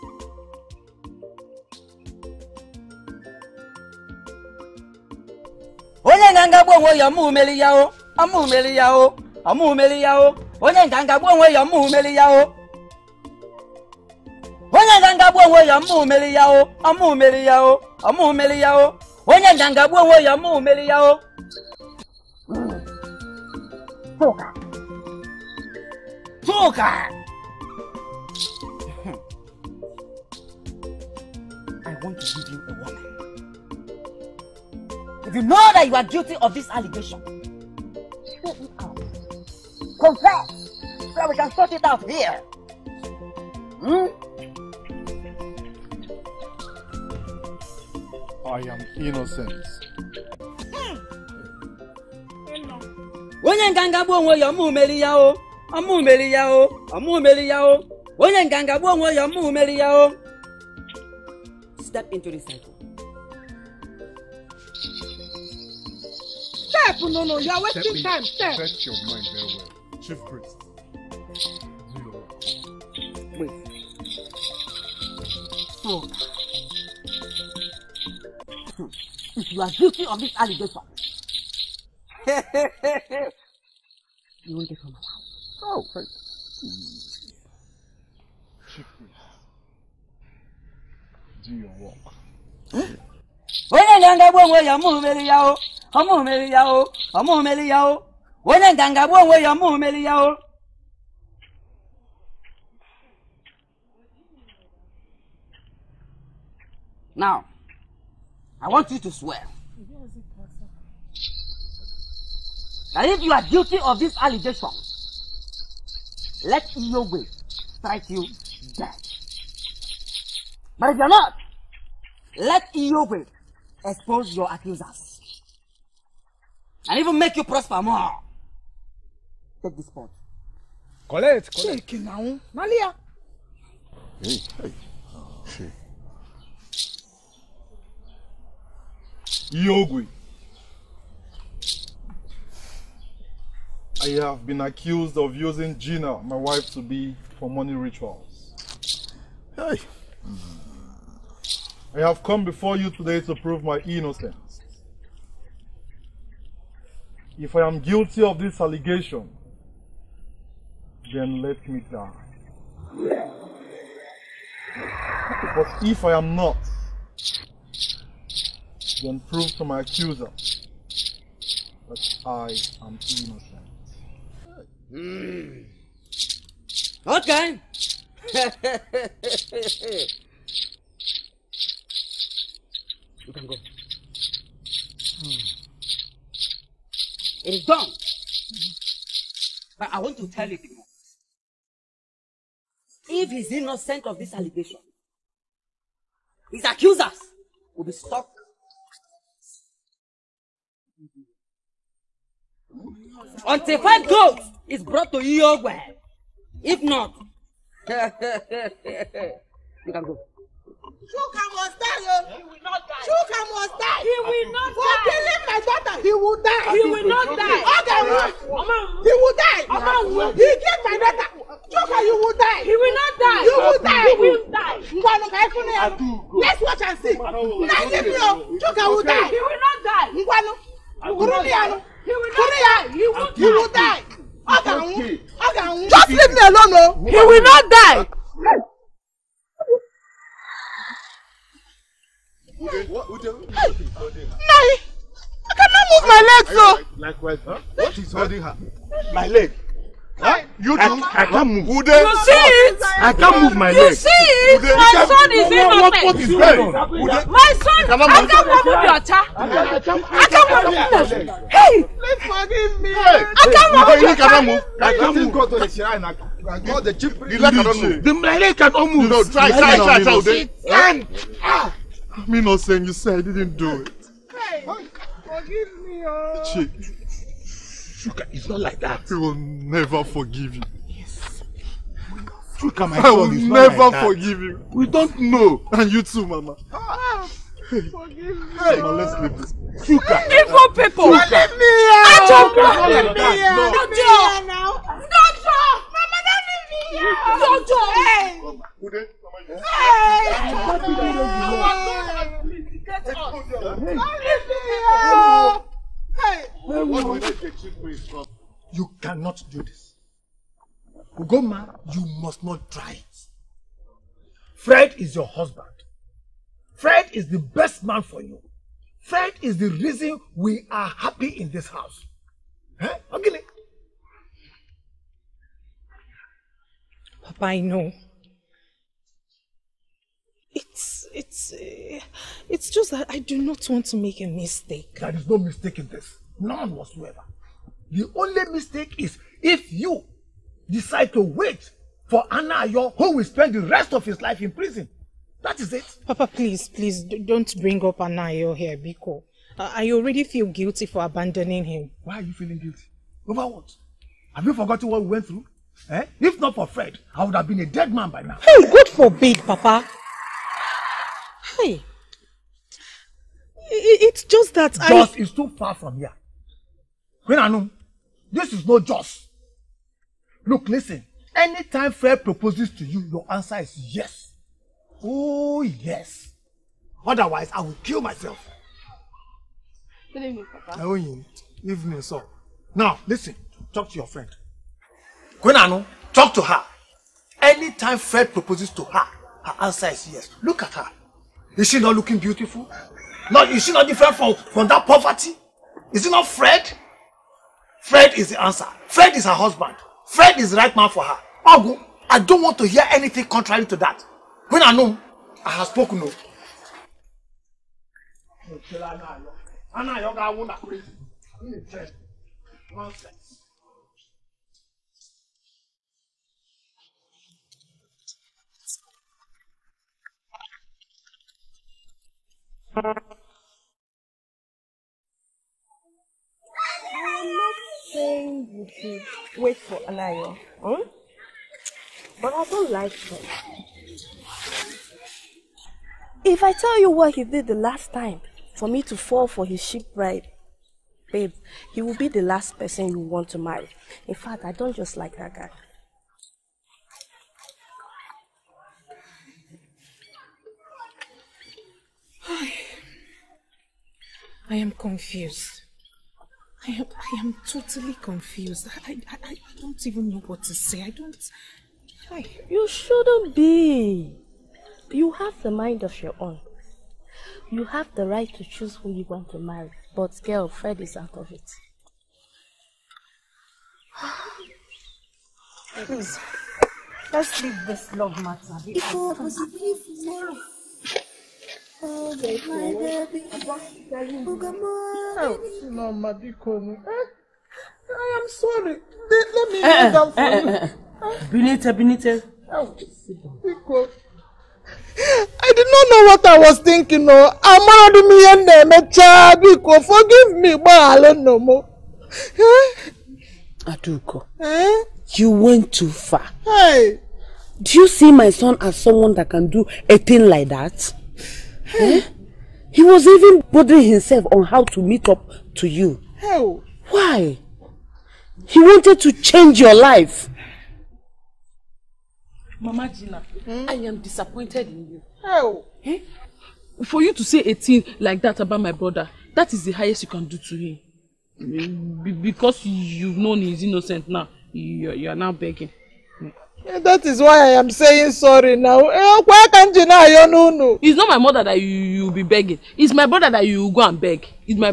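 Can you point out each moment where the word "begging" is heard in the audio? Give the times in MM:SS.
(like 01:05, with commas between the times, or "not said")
08:55, 09:02.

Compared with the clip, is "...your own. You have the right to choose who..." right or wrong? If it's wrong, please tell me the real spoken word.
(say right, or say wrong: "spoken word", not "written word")
right.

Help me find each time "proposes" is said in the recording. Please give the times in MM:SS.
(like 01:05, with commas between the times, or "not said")
06:12, 06:28.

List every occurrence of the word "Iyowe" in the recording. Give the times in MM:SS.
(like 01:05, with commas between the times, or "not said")
01:56, 02:02.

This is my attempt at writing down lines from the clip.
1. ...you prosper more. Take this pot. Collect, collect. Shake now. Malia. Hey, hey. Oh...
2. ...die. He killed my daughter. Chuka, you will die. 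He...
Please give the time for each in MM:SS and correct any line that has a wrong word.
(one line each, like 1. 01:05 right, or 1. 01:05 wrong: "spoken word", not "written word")
1. 02:07 right
2. 03:39 right.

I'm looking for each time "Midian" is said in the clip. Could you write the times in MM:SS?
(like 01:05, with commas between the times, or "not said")
not said.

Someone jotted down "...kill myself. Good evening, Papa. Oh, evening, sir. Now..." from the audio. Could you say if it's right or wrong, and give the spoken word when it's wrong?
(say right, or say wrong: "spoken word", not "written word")
right.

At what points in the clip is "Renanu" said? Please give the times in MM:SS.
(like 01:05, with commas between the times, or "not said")
06:07.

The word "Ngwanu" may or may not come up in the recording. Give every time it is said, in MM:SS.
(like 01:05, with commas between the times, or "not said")
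03:44, 03:50.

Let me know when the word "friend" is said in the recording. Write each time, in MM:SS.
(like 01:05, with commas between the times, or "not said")
06:24.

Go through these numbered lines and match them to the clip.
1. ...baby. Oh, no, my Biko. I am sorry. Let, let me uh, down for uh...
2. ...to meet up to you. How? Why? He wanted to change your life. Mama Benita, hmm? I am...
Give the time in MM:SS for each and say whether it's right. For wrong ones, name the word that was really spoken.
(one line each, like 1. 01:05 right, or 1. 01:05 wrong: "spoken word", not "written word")
1. 08:03 right
2. 08:34 wrong: "Gina", not "Benita".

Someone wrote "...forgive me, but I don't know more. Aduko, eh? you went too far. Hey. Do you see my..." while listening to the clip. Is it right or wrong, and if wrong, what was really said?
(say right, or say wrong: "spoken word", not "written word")
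right.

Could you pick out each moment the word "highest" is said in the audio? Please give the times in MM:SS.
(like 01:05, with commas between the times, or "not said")
08:49.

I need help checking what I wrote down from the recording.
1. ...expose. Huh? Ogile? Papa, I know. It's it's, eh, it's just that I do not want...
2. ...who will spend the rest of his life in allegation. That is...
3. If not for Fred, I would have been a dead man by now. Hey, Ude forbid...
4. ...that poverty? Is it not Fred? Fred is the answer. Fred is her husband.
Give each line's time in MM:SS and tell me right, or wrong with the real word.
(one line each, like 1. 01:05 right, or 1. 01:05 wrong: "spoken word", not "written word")
1. 05:21 wrong: "house", not "expose"
2. 05:42 wrong: "prison", not "allegation"
3. 05:56 wrong: "God", not "Ude"
4. 06:34 right.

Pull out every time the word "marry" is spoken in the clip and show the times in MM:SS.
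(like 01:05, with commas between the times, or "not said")
07:23, 07:49.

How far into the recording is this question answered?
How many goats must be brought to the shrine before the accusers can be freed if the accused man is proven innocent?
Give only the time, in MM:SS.
03:23.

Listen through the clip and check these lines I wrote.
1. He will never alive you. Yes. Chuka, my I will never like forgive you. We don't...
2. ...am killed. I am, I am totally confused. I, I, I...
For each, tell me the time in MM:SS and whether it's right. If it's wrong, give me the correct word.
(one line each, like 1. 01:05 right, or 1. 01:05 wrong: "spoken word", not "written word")
1. 04:39 wrong: "forgive", not "alive"
2. 07:34 wrong: "confused", not "killed".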